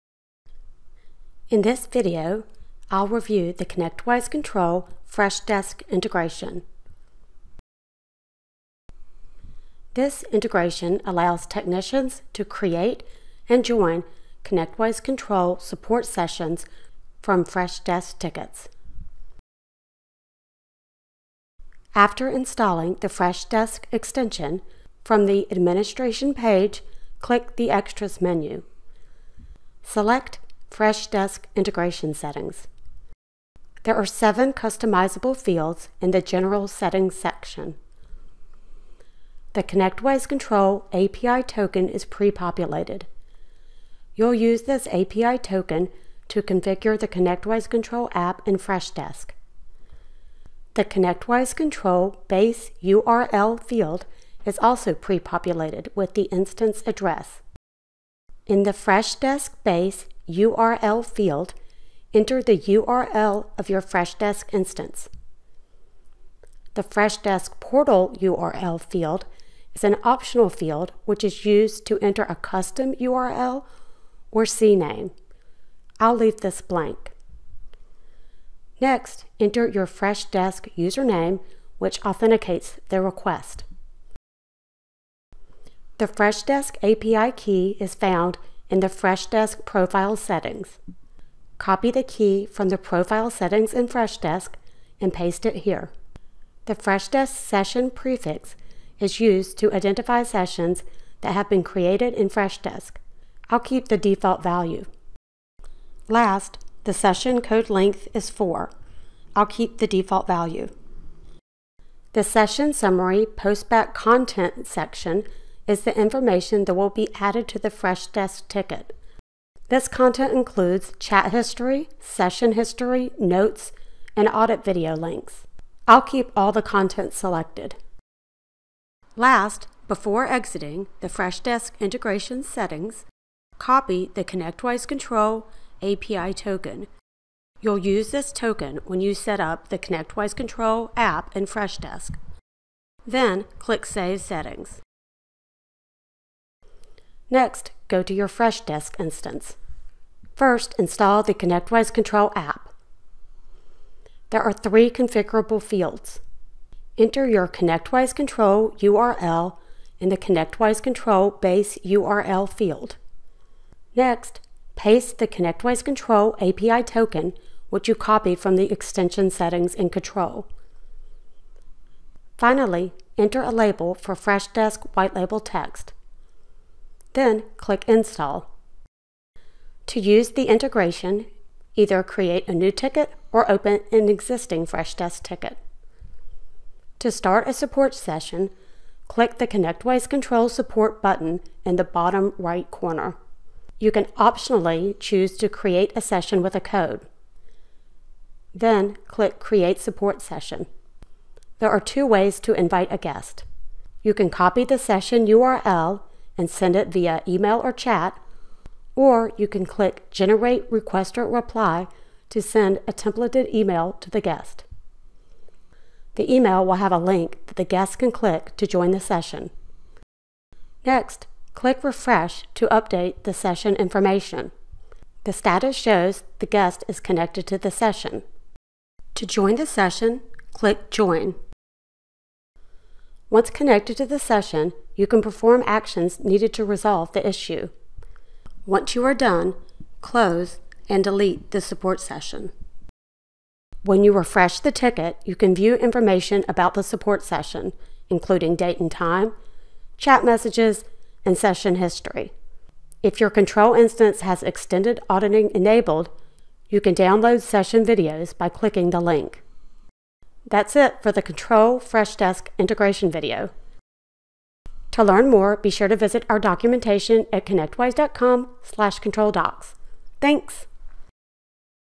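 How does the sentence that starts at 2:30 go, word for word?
First, install the ConnectWise Control app.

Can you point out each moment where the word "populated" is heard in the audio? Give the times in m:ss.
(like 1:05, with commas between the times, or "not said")
0:42, 0:54.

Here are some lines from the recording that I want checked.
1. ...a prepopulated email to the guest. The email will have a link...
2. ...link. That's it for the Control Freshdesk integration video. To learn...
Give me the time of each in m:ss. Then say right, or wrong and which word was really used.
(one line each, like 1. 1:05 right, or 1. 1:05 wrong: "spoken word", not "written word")
1. 3:32 wrong: "templated", not "prepopulated"
2. 4:18 right.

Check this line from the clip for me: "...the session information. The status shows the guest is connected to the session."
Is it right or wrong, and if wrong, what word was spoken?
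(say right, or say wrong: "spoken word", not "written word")
right.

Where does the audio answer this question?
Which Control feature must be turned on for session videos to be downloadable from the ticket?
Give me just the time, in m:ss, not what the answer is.
4:14.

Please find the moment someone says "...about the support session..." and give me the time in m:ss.
4:06.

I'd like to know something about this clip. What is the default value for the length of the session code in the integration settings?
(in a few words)
4.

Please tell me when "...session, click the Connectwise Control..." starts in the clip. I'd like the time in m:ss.
3:07.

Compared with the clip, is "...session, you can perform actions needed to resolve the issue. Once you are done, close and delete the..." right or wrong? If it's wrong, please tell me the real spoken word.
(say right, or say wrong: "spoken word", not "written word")
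right.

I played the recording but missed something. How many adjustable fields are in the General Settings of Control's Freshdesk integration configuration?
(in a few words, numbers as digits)
7.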